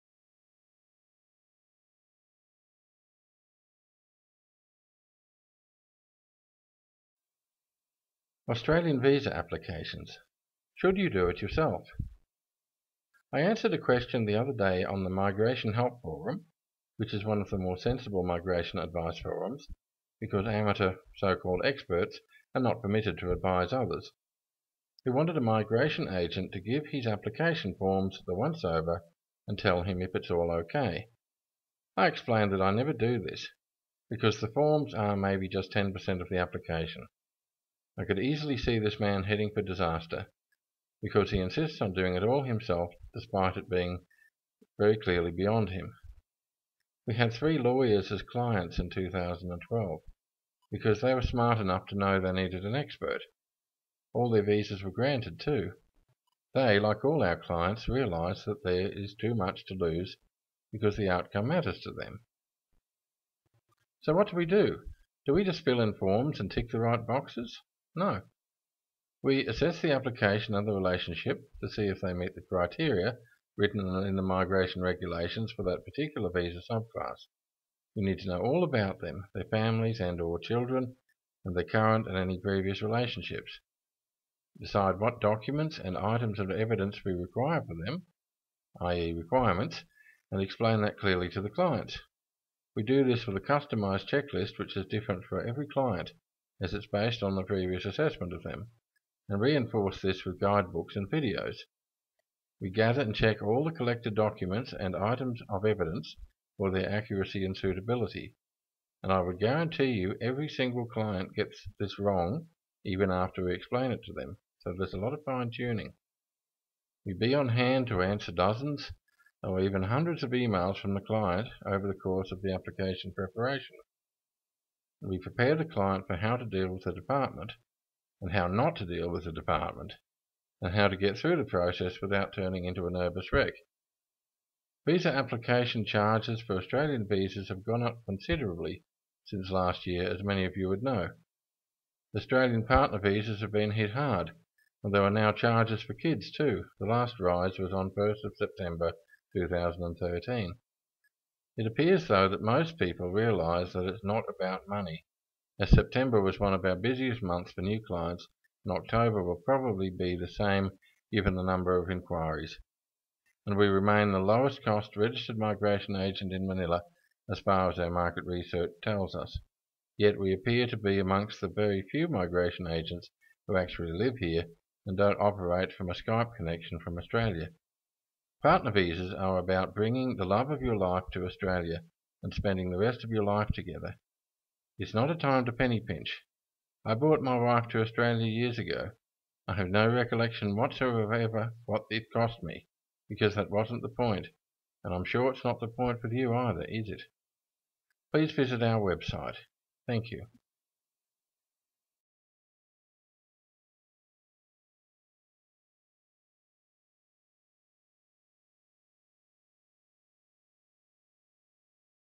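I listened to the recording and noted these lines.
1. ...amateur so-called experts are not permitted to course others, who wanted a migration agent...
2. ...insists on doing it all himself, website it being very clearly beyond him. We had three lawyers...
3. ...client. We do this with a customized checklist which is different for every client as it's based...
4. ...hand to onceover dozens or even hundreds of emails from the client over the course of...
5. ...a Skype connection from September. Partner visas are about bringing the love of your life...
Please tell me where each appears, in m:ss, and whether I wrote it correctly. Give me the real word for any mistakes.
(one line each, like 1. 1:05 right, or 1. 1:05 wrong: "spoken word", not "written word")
1. 0:20 wrong: "advise", not "course"
2. 0:41 wrong: "despite", not "website"
3. 1:31 right
4. 1:57 wrong: "answer", not "onceover"
5. 2:55 wrong: "Australia", not "September".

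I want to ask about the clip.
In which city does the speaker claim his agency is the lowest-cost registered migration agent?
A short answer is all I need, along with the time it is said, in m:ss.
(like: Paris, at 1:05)
Manila, at 2:46.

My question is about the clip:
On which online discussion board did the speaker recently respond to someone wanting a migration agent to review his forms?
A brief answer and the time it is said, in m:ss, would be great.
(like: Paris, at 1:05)
Migration Help Forum, at 0:15.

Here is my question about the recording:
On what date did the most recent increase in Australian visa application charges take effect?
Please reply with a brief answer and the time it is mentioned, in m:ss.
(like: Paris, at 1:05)
1 September 2013, at 2:27.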